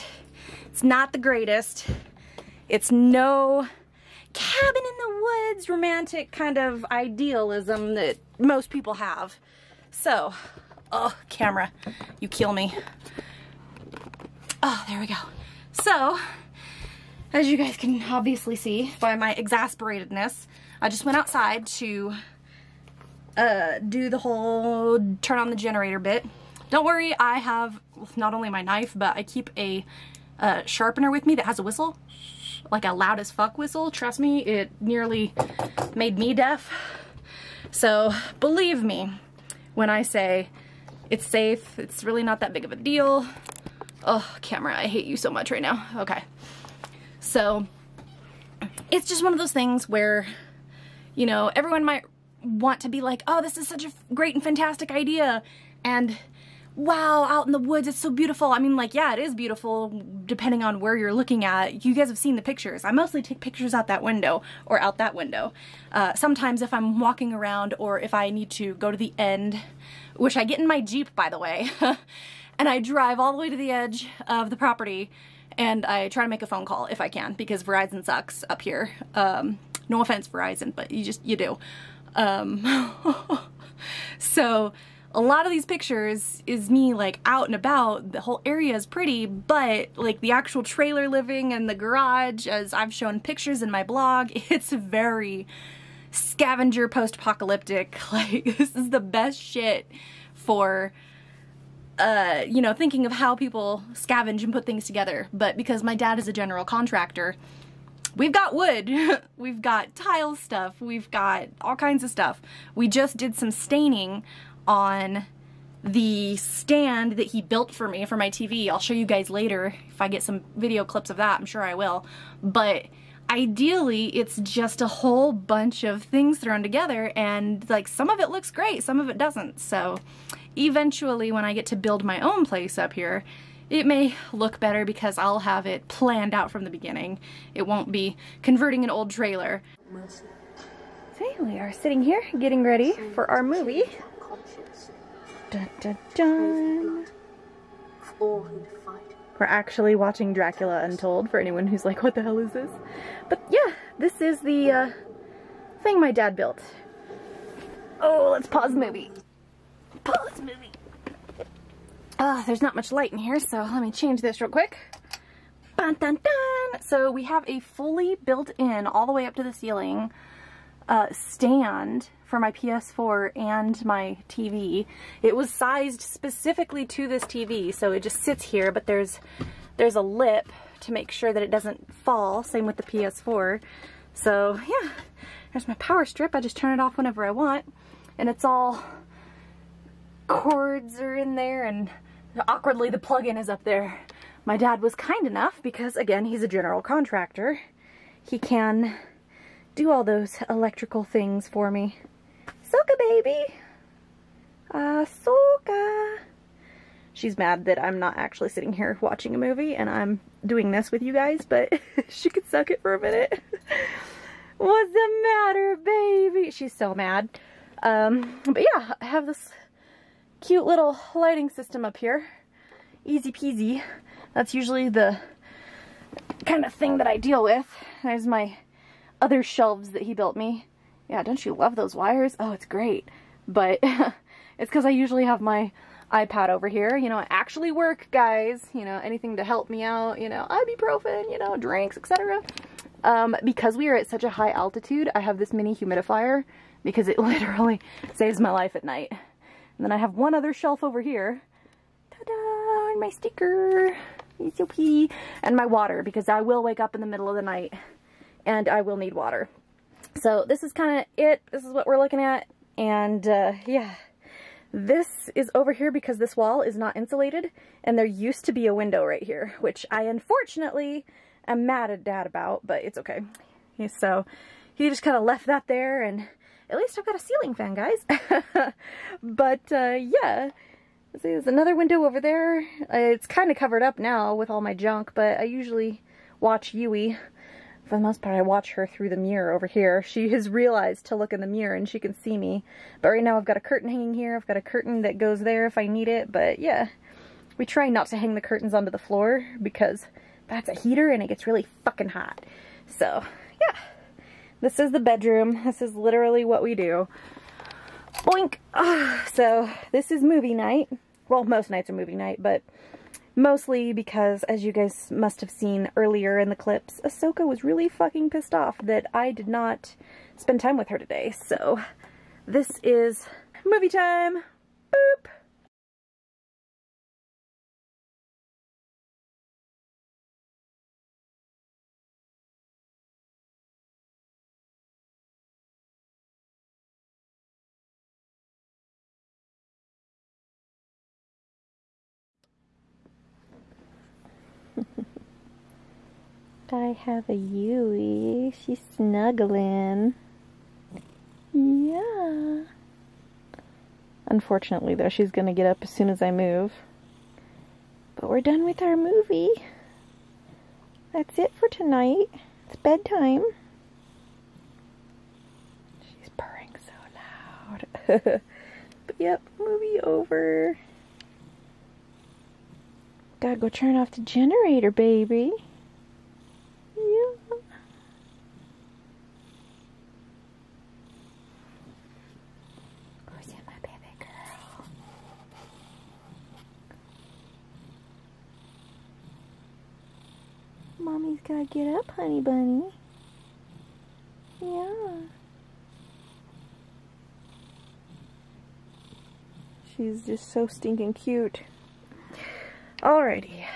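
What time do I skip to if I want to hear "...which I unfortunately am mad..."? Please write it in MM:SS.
04:29.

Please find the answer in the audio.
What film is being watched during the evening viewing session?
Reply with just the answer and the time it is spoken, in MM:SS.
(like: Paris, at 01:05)
Dracula Untold, at 02:30.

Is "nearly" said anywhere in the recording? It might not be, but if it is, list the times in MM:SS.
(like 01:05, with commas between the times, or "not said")
00:34.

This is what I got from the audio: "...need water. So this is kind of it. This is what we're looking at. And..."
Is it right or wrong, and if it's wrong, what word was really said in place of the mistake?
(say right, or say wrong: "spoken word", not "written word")
right.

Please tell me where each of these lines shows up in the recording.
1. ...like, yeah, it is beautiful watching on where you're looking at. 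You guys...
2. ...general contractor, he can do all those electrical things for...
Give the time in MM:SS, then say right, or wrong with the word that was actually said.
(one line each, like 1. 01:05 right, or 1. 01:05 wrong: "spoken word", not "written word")
1. 00:58 wrong: "depending", not "watching"
2. 03:16 right.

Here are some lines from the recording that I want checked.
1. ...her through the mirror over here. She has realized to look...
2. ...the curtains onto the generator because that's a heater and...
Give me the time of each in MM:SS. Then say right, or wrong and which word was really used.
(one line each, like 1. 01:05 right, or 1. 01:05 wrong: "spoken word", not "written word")
1. 04:48 right
2. 04:58 wrong: "floor", not "generator".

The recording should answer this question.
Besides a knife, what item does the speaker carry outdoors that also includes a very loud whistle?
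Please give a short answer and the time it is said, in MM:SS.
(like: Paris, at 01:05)
sharpener, at 00:30.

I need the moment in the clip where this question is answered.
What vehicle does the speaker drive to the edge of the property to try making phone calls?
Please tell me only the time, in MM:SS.
01:10.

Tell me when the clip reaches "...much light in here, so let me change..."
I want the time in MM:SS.
02:42.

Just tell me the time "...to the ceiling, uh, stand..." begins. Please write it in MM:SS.
02:49.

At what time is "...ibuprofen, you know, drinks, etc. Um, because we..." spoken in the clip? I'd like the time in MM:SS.
04:00.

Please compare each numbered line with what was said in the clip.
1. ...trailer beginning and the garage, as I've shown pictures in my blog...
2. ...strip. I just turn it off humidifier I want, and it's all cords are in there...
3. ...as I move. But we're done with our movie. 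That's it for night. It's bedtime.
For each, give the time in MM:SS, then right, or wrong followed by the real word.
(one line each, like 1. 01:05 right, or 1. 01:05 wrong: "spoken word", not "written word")
1. 01:30 wrong: "living", not "beginning"
2. 03:06 wrong: "whenever", not "humidifier"
3. 05:56 wrong: "tonight", not "night".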